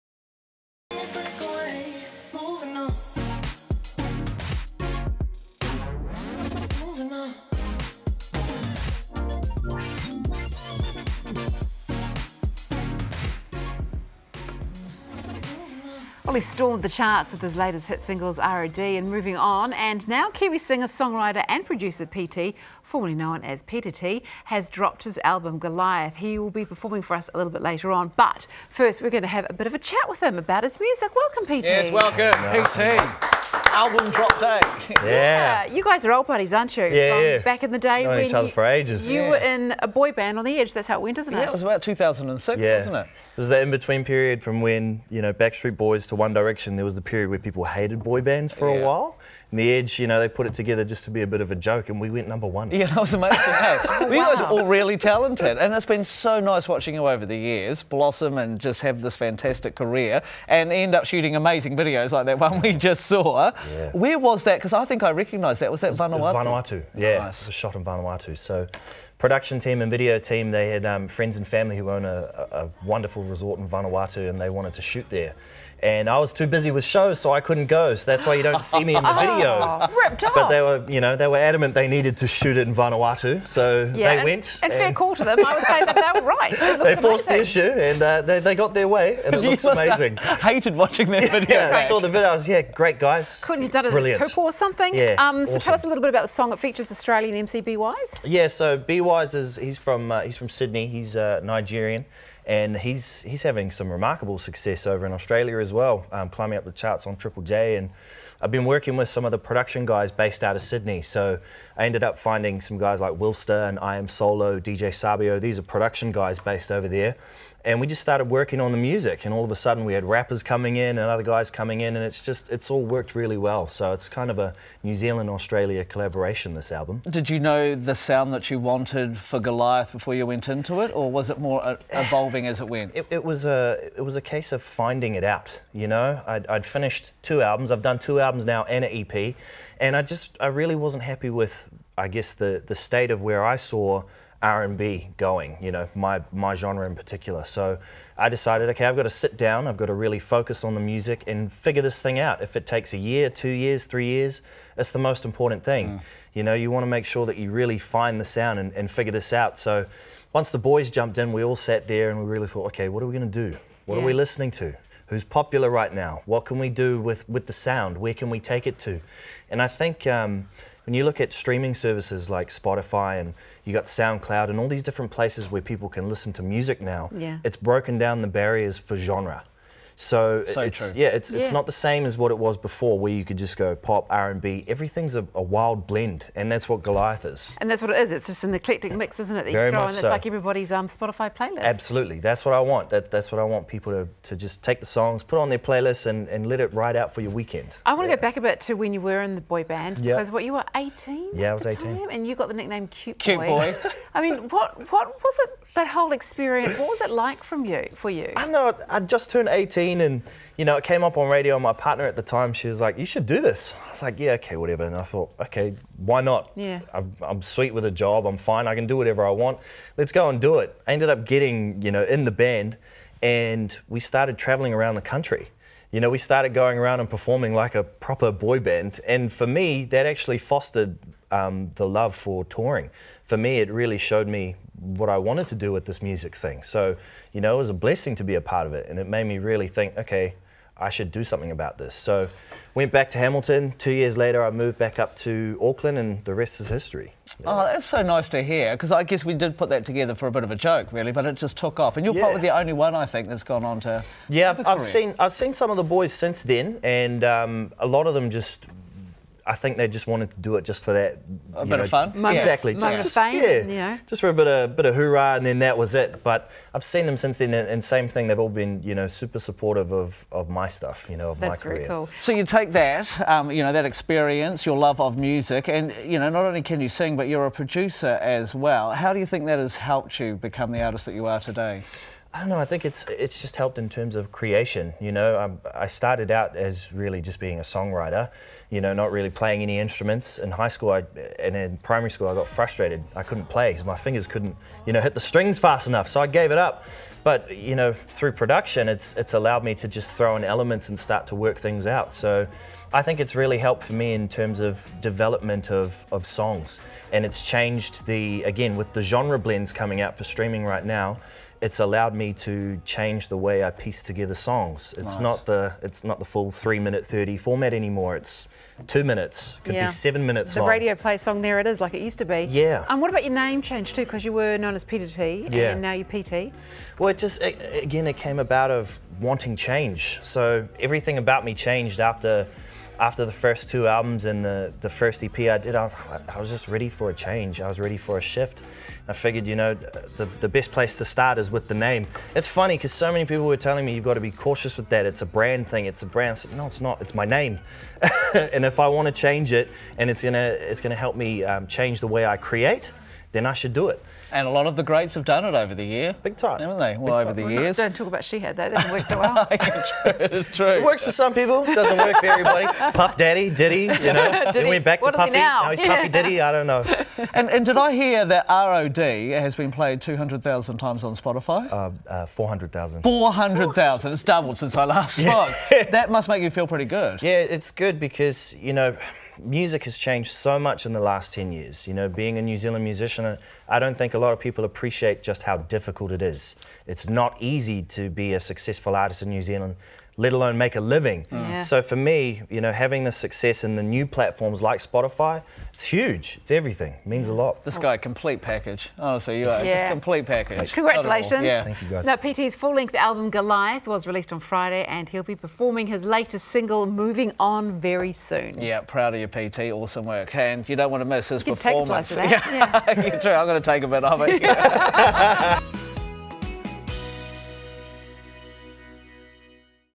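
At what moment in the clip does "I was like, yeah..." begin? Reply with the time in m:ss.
3:33.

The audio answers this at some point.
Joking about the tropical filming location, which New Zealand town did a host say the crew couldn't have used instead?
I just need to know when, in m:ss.
1:34.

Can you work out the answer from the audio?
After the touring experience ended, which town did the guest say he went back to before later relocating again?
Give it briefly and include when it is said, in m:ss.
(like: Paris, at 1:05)
Hamilton, at 4:03.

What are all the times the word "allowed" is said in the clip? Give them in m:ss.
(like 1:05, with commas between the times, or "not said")
4:59, 5:11.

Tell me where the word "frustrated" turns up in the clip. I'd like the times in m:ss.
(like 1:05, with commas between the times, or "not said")
4:52.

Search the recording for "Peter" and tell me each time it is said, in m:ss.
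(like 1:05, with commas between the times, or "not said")
0:23, 5:24.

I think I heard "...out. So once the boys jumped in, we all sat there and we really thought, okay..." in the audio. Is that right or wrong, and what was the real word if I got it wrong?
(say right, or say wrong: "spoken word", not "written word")
right.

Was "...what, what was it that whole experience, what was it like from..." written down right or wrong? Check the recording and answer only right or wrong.
right.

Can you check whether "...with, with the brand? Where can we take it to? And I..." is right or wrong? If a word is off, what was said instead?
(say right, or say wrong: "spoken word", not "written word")
wrong: "sound", not "brand".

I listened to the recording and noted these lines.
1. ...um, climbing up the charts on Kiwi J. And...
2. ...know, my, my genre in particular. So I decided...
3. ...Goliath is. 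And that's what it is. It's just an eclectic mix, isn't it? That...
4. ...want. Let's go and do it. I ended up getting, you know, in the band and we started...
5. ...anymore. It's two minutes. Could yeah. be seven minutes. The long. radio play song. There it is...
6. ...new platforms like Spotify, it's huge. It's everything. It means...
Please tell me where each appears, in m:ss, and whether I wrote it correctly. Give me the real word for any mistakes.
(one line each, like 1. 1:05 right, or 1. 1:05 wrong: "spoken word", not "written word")
1. 1:46 wrong: "Triple", not "Kiwi"
2. 2:25 right
3. 3:06 right
4. 3:39 right
5. 5:17 right
6. 6:33 right.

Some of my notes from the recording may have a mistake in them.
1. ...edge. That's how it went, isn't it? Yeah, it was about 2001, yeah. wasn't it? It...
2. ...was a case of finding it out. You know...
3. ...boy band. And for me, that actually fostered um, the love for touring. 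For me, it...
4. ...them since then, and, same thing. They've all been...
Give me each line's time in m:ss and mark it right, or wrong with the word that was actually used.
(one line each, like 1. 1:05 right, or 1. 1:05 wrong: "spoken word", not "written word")
1. 0:40 wrong: "2006", not "2001"
2. 2:14 right
3. 3:48 right
4. 4:27 right.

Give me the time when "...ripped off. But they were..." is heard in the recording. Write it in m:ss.
1:20.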